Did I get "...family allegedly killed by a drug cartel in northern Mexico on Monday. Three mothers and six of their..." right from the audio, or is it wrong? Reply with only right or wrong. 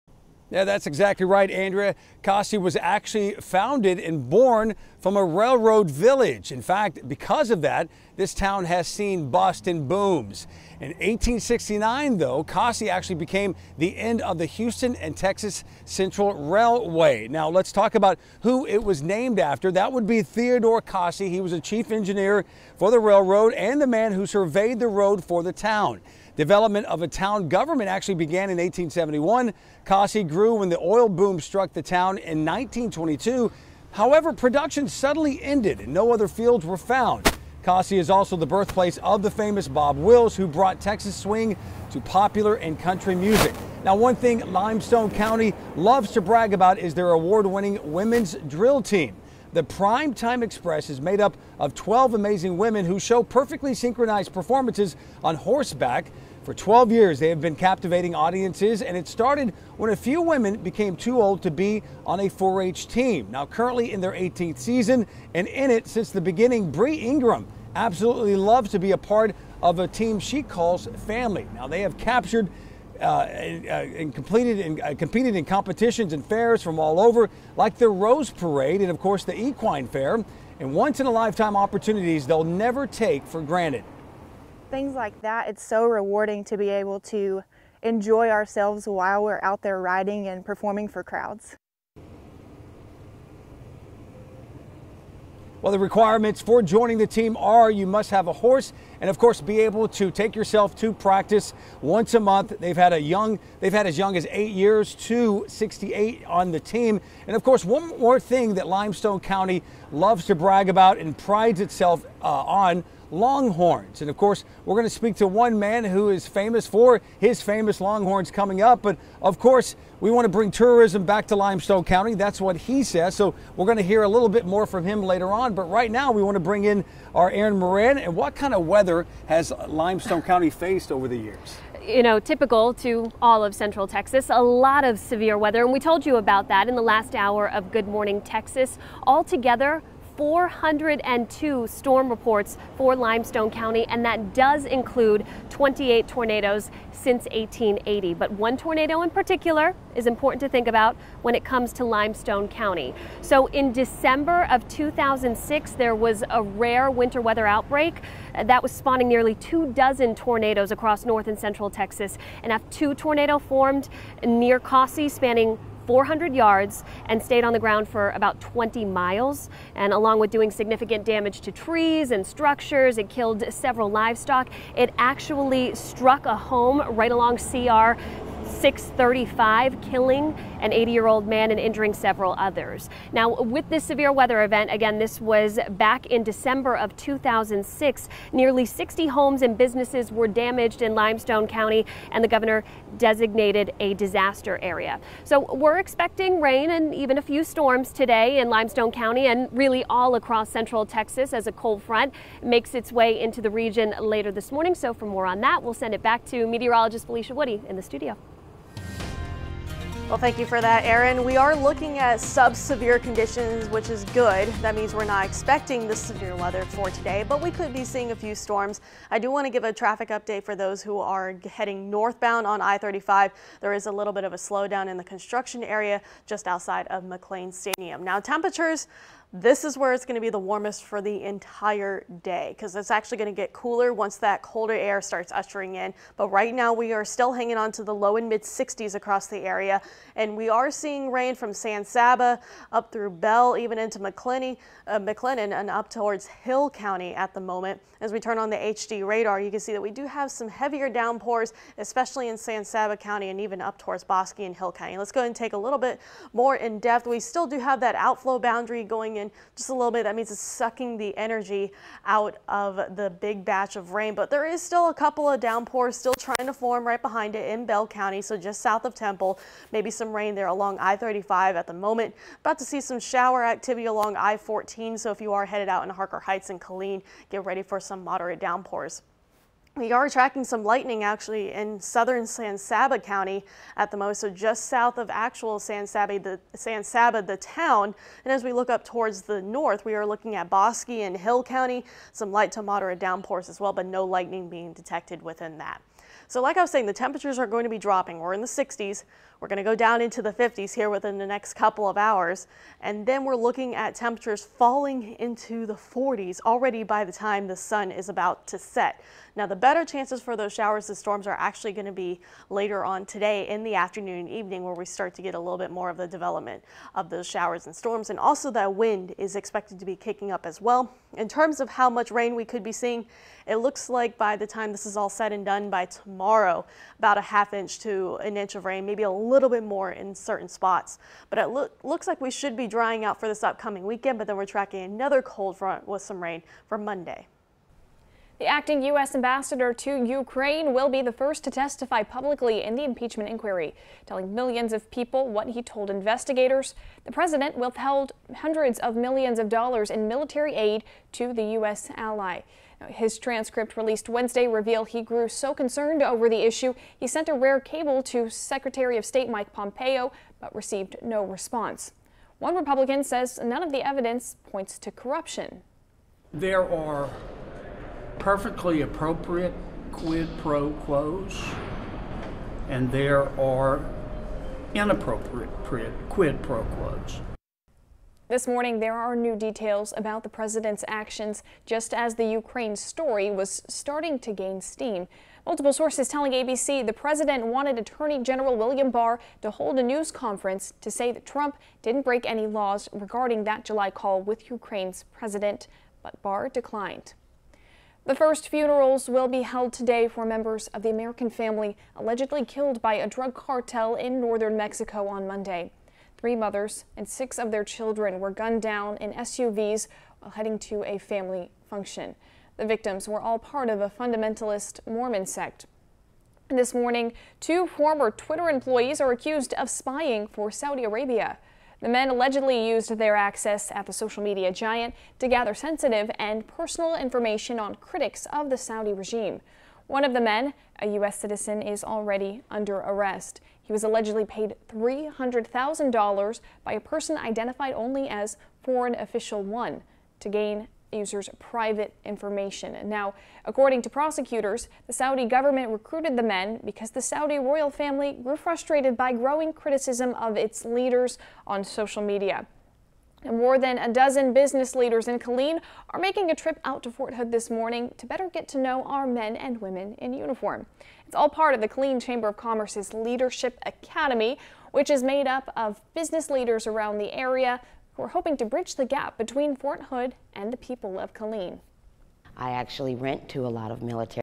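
right.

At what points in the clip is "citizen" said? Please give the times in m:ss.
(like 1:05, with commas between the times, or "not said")
7:11.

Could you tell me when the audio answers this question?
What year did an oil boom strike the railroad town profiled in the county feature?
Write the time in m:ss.
0:32.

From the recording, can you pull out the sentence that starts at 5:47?
The president withheld hundreds of millions of dollars in military aid to the U.S.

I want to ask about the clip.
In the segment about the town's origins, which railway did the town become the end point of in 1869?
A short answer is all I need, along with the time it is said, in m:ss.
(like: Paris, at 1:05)
Houston and Texas Central Railway, at 0:14.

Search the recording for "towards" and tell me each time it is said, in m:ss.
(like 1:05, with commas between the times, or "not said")
4:05, 4:13, 4:48.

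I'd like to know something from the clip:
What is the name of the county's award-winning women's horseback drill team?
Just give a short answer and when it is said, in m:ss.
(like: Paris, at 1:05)
Prime Time Express, at 0:49.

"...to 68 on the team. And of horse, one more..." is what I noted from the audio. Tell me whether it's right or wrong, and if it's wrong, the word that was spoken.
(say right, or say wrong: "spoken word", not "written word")
wrong: "course", not "horse".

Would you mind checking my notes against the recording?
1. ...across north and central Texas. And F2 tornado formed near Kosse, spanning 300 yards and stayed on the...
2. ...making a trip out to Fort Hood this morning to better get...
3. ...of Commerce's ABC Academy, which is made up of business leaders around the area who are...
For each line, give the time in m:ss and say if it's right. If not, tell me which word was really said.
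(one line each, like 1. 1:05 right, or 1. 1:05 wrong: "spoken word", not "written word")
1. 2:40 wrong: "400", not "300"
2. 7:35 right
3. 7:42 wrong: "Leadership", not "ABC".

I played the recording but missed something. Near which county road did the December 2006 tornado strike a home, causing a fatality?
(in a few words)
CR 635.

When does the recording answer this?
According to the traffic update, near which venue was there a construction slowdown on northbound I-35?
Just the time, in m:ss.
3:47.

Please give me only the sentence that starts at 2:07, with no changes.
And what kind of weather has Limestone County faced over the years?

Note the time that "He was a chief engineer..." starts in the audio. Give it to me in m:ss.
0:21.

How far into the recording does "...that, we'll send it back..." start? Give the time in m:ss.
3:25.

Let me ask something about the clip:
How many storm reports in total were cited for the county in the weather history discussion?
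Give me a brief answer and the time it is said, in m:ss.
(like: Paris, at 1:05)
402, at 2:20.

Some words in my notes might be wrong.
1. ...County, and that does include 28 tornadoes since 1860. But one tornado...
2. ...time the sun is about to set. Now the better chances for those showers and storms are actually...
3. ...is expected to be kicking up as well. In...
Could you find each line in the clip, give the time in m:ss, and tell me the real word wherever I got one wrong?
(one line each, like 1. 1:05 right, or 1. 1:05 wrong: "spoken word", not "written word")
1. 2:23 wrong: "1880", not "1860"
2. 5:07 right
3. 5:19 right.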